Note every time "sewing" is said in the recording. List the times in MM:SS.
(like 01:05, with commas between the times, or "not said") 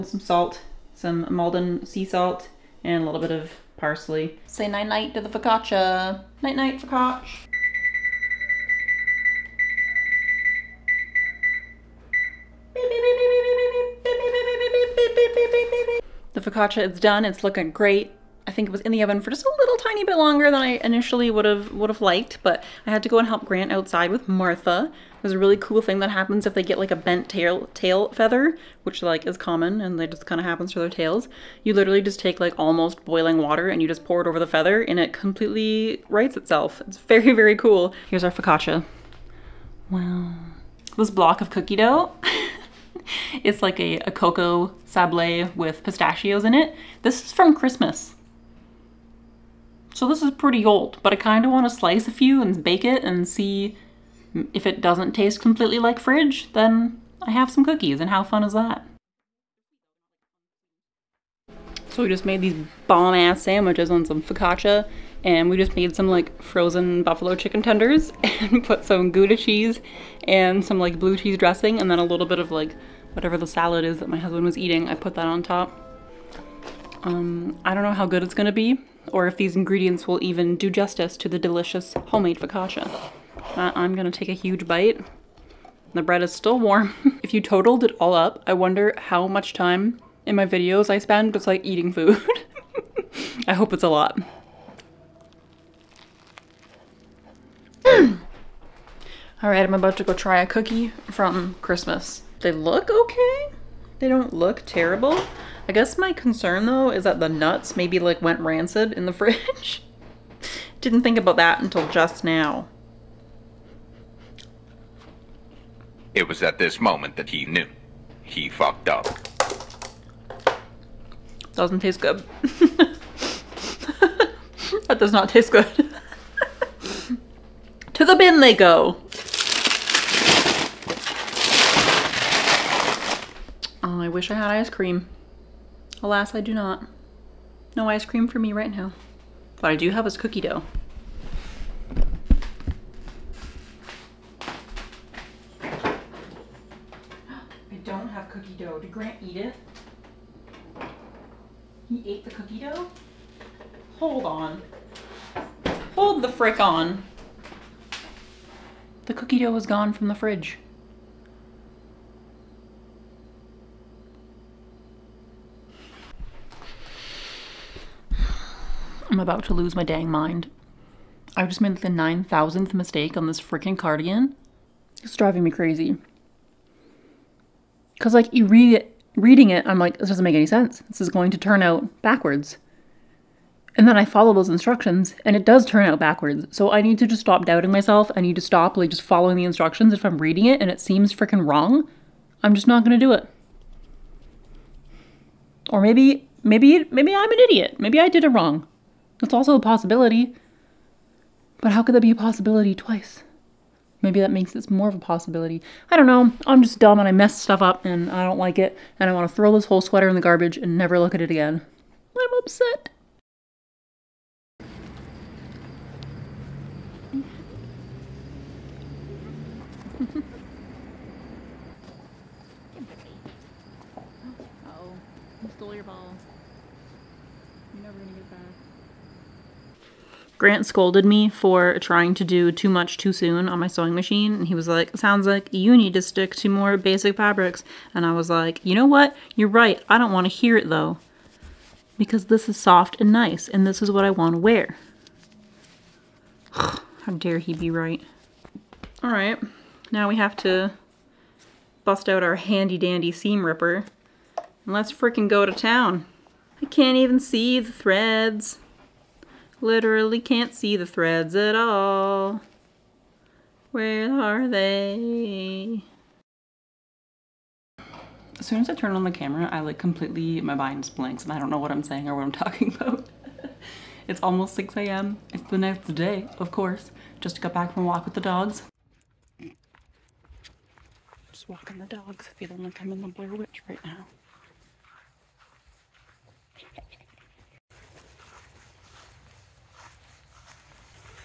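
03:53.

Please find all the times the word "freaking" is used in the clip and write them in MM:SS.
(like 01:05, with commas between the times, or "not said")
02:53, 03:11, 04:14.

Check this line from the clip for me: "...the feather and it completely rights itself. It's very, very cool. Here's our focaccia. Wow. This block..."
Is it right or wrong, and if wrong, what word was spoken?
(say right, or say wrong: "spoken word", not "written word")
right.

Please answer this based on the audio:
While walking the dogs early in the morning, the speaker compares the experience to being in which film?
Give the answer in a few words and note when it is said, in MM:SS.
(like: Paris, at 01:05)
The Blair Witch, at 04:43.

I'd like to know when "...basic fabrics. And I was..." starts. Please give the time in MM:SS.
03:56.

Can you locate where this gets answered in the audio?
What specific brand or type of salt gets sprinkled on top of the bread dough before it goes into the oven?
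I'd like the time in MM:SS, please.
00:01.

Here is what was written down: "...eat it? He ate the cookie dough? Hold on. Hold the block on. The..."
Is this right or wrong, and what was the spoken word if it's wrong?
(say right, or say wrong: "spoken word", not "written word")
wrong: "frick", not "block".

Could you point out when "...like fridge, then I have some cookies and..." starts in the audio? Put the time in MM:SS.
00:55.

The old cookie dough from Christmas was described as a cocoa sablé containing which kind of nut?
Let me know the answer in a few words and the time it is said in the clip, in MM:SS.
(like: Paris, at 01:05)
Pistachios, at 00:45.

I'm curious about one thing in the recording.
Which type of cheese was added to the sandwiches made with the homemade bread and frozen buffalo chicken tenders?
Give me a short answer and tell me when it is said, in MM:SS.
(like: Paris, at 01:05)
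Gouda, at 01:09.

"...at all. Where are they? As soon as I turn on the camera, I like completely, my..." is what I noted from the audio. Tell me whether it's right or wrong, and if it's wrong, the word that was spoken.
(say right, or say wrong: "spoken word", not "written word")
right.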